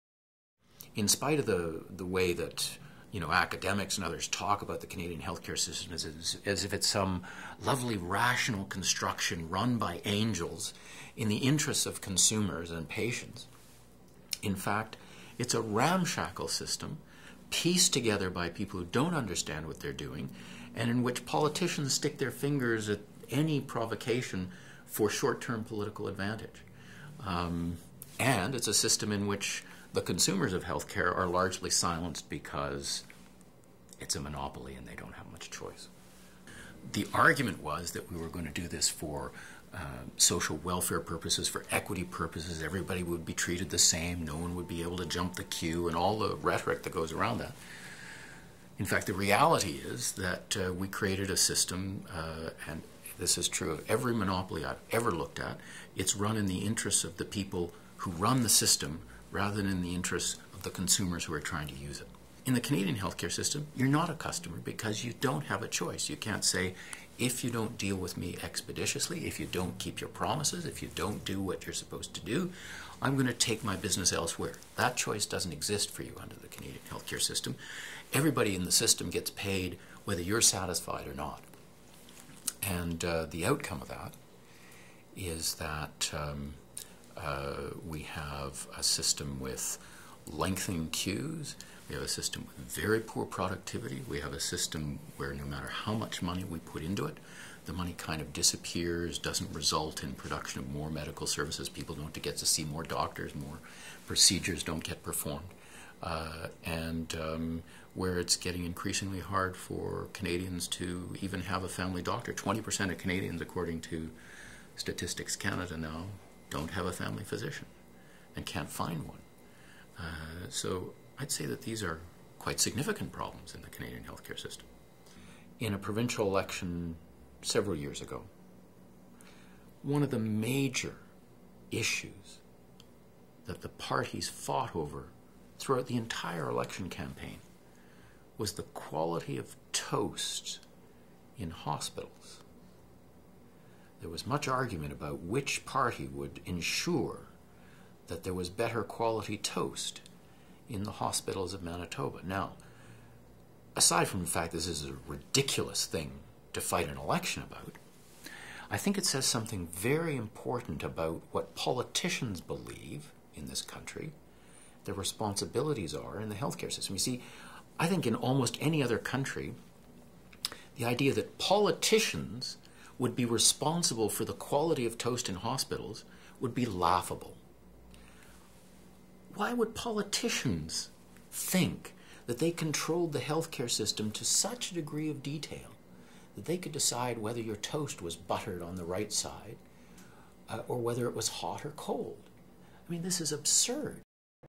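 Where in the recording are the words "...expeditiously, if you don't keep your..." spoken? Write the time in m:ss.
1:08.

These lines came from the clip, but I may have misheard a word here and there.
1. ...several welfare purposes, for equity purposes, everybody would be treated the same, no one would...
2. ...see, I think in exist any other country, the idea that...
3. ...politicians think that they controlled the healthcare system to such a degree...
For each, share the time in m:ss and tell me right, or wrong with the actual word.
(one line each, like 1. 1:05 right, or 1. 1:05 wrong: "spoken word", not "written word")
1. 0:40 wrong: "social", not "several"
2. 2:46 wrong: "almost", not "exist"
3. 2:59 right.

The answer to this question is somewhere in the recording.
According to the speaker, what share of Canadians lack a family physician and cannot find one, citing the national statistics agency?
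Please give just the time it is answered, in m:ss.
1:52.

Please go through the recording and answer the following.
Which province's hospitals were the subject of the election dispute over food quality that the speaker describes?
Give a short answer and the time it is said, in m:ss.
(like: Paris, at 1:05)
Manitoba, at 2:31.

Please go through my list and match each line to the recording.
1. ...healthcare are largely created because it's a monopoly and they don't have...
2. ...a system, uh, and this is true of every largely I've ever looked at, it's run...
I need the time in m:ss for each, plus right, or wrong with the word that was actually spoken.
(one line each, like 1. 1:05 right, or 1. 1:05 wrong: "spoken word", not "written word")
1. 0:30 wrong: "silenced", not "created"
2. 0:51 wrong: "monopoly", not "largely".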